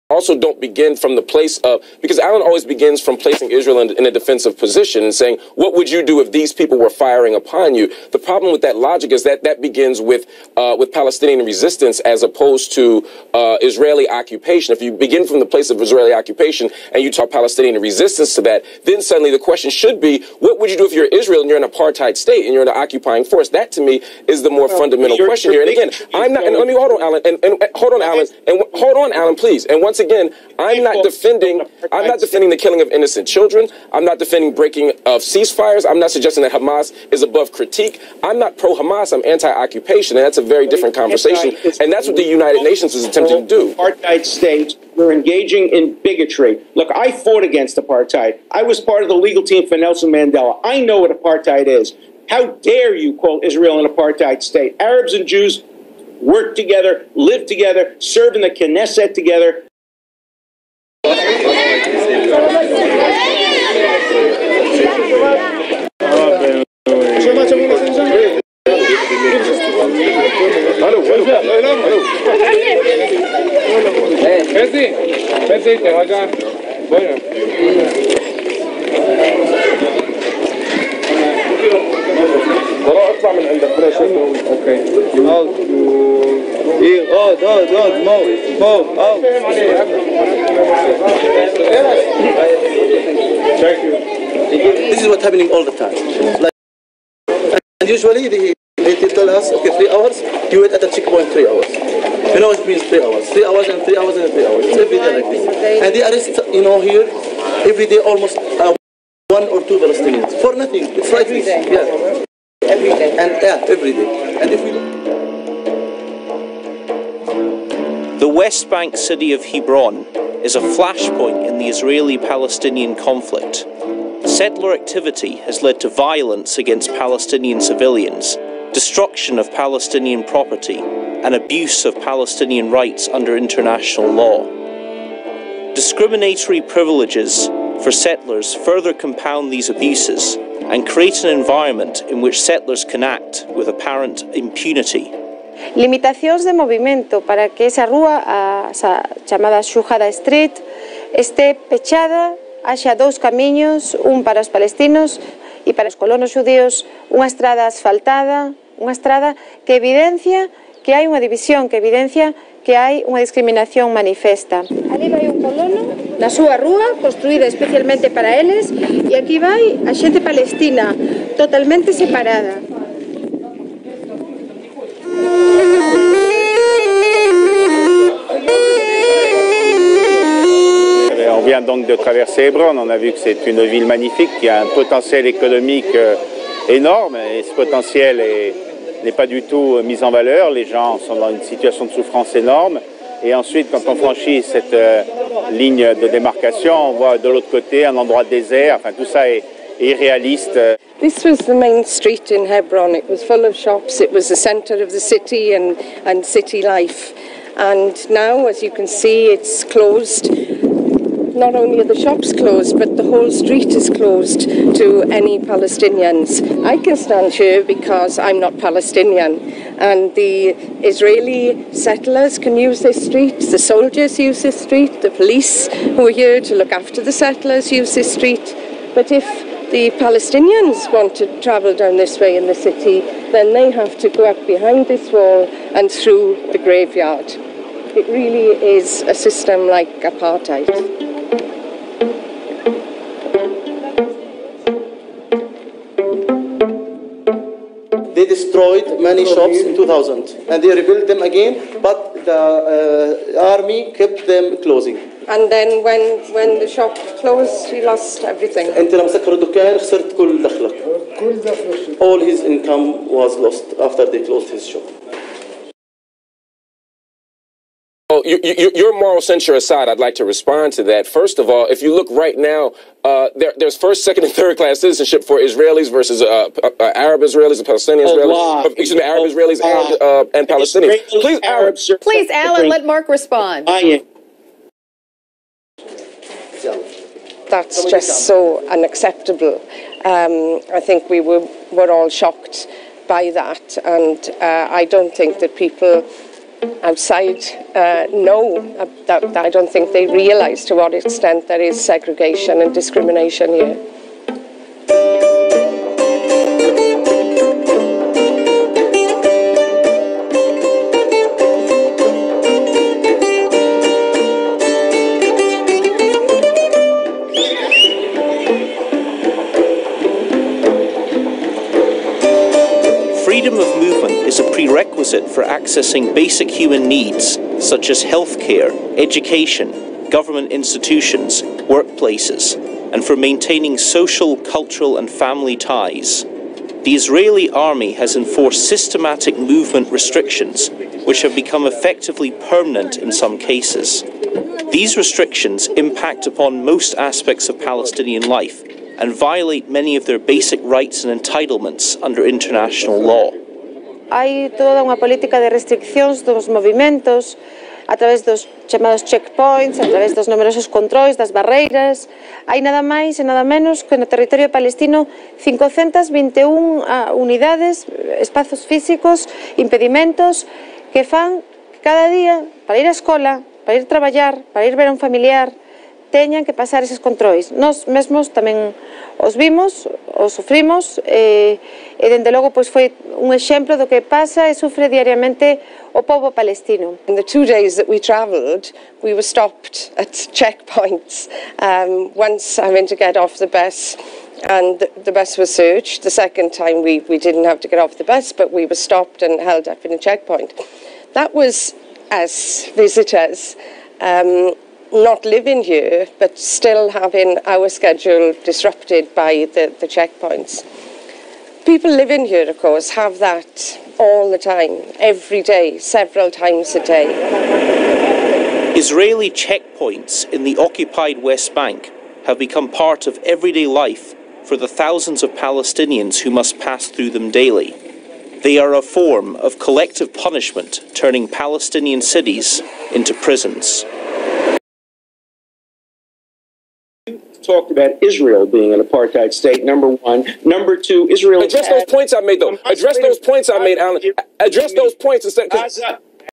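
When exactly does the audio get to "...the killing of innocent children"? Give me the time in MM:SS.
00:32.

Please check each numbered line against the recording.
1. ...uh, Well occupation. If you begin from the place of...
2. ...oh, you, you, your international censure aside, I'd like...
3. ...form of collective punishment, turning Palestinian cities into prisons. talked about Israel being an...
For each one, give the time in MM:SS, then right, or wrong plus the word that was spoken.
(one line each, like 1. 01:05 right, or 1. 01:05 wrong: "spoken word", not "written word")
1. 00:13 wrong: "Israeli", not "Well"
2. 04:28 wrong: "moral", not "international"
3. 07:08 right.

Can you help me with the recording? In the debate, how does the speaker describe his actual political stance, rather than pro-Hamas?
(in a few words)
anti-occupation.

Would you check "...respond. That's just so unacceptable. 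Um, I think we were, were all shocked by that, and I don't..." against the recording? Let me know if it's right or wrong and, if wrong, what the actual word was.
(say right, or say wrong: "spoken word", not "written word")
right.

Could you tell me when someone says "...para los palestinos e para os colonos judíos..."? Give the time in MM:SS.
02:34.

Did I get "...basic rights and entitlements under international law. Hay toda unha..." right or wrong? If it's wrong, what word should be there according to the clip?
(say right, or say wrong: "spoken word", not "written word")
right.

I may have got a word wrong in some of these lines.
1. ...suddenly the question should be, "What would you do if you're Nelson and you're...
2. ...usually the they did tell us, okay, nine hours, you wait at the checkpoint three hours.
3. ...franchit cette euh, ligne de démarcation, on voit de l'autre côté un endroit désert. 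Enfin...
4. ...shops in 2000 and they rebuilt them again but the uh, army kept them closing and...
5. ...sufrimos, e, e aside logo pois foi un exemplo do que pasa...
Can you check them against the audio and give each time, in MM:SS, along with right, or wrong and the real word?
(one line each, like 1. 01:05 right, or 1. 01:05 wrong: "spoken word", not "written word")
1. 00:19 wrong: "Israel", not "Nelson"
2. 01:37 wrong: "three", not "nine"
3. 03:13 right
4. 04:09 right
5. 06:20 wrong: "dende", not "aside".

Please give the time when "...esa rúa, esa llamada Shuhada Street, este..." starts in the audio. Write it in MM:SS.
02:27.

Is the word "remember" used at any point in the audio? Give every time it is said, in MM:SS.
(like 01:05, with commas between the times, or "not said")
not said.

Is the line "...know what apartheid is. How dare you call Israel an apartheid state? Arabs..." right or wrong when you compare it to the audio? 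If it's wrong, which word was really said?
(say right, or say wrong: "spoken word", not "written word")
right.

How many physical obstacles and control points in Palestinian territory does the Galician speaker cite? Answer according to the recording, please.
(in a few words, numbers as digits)
521.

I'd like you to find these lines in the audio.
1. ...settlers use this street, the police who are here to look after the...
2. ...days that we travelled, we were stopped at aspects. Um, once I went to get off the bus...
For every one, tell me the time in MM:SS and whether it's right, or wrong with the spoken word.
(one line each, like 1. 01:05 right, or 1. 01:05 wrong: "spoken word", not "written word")
1. 03:43 wrong: "soldiers", not "settlers"
2. 06:27 wrong: "checkpoints", not "aspects".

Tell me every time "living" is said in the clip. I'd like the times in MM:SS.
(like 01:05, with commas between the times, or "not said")
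06:45, 06:51.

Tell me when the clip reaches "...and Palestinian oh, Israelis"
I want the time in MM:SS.
04:37.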